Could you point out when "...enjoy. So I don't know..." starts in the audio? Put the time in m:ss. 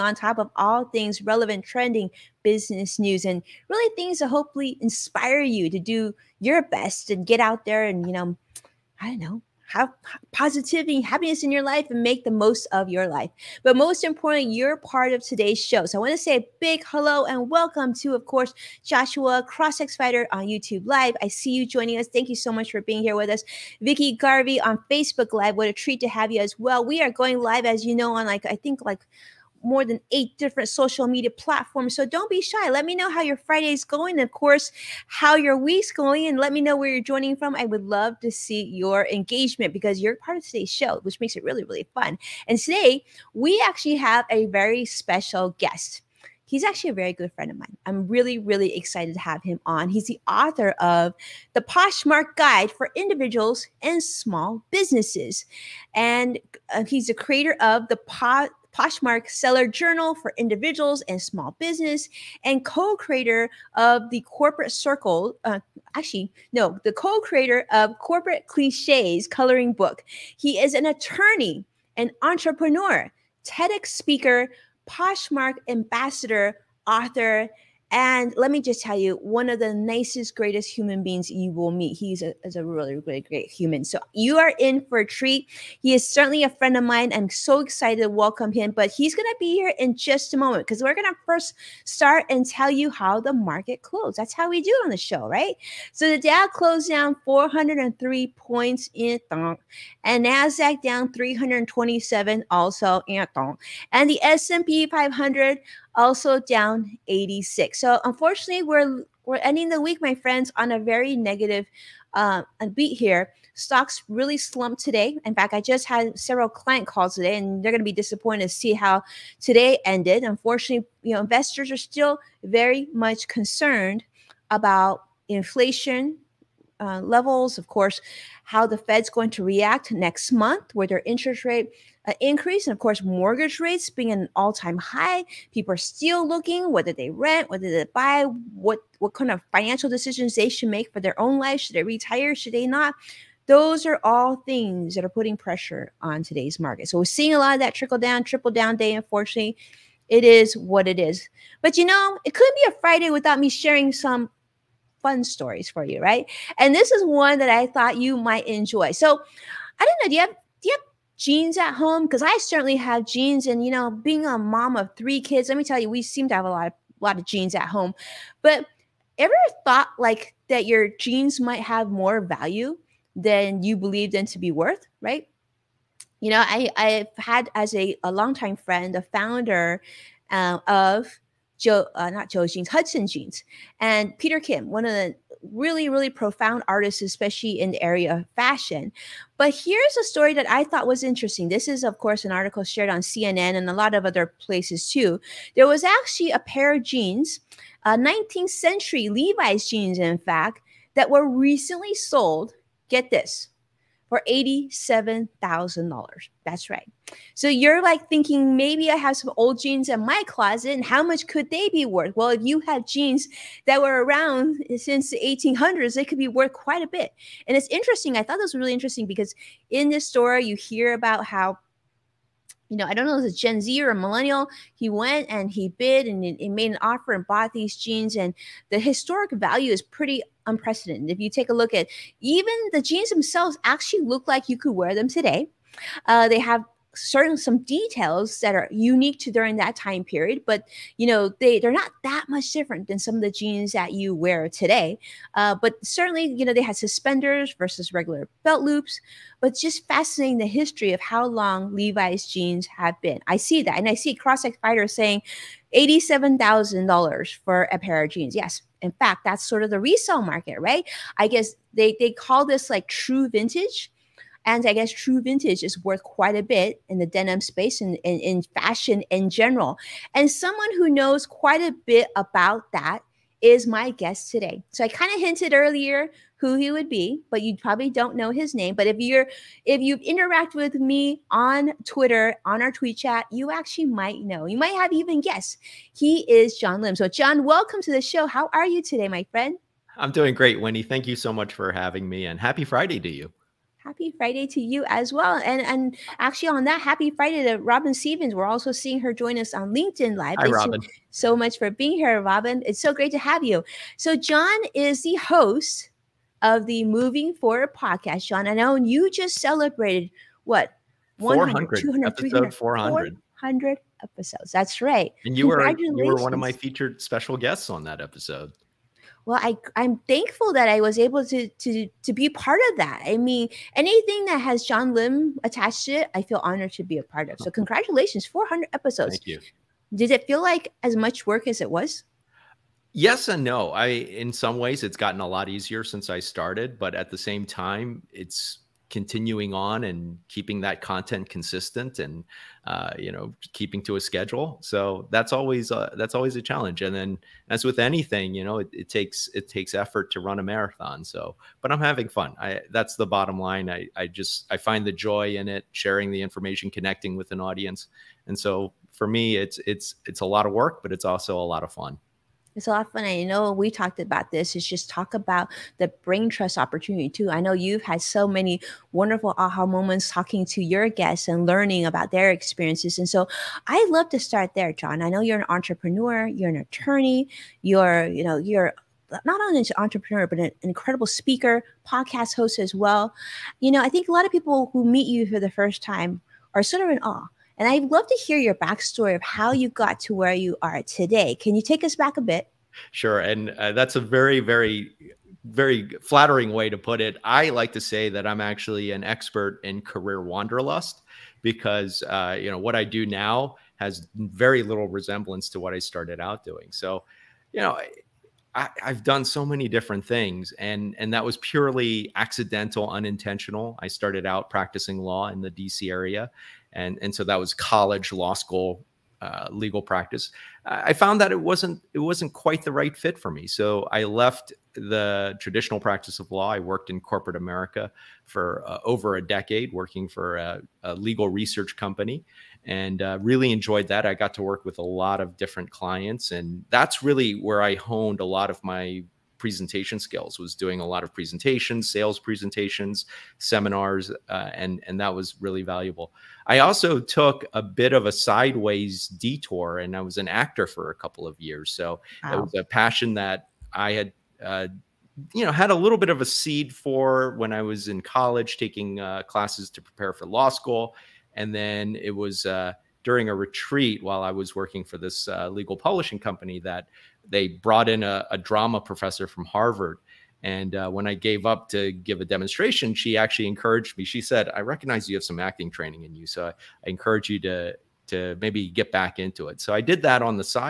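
2:38.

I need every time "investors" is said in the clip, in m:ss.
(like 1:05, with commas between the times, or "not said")
2:01.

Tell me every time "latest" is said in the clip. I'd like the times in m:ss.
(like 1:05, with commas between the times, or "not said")
not said.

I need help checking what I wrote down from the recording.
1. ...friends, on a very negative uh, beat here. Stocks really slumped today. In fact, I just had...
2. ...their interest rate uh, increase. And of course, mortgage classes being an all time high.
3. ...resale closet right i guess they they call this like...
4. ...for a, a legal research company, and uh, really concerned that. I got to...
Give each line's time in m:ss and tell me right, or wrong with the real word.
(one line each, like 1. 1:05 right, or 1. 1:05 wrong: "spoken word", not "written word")
1. 1:50 right
2. 2:10 wrong: "rates", not "classes"
3. 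4:19 wrong: "market", not "closet"
4. 7:10 wrong: "enjoyed", not "concerned".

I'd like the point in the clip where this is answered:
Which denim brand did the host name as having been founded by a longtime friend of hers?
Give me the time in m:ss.
3:02.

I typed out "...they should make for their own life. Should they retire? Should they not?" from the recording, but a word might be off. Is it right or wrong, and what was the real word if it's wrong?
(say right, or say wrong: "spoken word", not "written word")
right.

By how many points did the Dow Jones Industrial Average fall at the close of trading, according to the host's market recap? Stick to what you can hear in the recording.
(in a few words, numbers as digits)
403.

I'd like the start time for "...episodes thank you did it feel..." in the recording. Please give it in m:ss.
5:28.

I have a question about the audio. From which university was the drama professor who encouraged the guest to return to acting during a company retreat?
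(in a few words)
Harvard.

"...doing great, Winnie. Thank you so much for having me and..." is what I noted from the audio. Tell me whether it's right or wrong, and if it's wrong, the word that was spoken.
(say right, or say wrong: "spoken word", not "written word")
right.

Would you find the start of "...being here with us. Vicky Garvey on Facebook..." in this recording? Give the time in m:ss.
0:22.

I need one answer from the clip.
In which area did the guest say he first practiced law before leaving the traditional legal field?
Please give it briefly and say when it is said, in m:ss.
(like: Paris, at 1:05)
D.C. area, at 6:55.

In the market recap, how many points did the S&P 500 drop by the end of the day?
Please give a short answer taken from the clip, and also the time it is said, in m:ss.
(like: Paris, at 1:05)
86, at 1:47.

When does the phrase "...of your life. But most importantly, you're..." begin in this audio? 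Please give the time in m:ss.
0:12.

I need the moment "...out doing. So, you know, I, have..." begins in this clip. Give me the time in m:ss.
6:46.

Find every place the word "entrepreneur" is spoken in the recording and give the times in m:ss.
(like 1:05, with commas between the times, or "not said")
1:12, 6:15, 6:19.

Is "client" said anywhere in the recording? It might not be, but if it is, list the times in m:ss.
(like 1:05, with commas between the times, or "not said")
1:56, 7:15.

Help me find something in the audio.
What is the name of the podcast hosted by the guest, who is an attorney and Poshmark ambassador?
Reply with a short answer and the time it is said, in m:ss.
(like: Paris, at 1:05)
Moving Forward, at 5:06.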